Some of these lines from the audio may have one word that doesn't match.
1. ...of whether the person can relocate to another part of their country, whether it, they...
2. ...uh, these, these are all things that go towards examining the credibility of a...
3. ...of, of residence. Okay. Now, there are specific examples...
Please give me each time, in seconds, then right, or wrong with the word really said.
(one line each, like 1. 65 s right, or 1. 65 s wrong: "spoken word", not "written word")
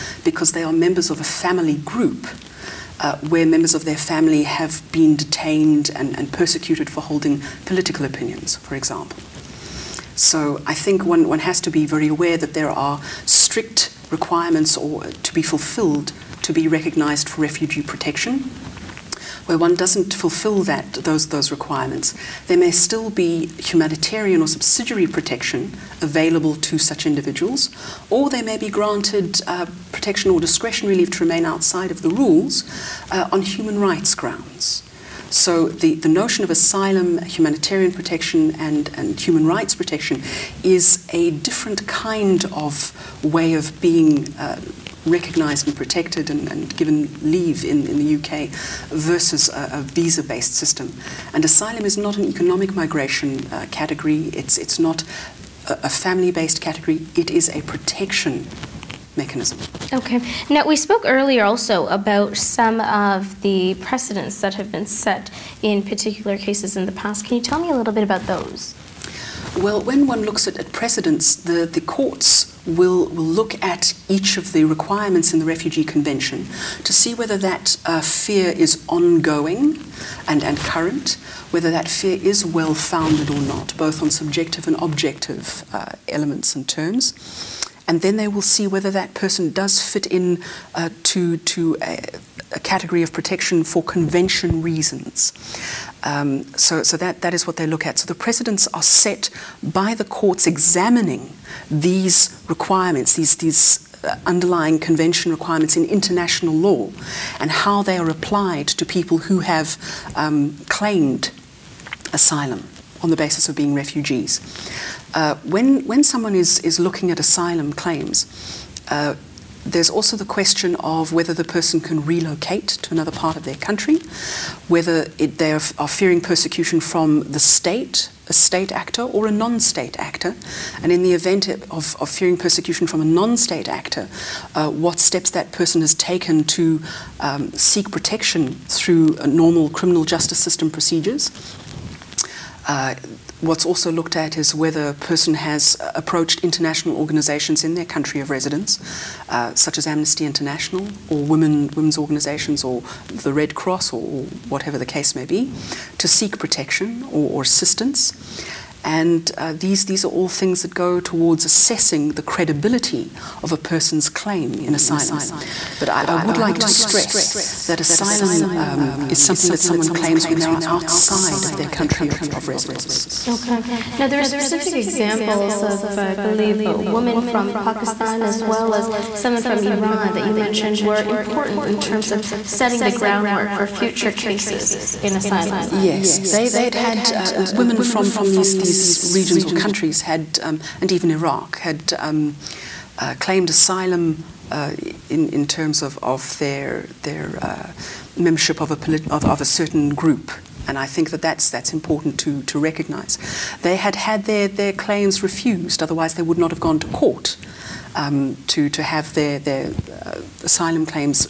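1. 120 s right
2. 159 s wrong: "assessing", not "examining"
3. 172 s right.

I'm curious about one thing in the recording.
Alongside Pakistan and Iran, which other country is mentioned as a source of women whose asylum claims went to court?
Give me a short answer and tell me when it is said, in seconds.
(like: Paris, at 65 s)
Iraq, at 191 s.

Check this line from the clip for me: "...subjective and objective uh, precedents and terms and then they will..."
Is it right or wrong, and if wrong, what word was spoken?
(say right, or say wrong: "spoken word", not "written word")
wrong: "elements", not "precedents".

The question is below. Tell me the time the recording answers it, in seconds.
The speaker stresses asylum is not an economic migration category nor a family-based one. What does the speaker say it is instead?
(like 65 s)
57 s.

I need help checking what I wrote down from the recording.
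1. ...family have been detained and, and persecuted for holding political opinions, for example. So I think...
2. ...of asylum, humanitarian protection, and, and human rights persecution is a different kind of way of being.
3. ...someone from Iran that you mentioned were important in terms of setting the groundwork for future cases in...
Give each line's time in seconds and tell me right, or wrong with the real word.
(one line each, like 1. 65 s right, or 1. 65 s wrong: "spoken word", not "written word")
1. 3 s right
2. 36 s wrong: "protection", not "persecution"
3. 179 s right.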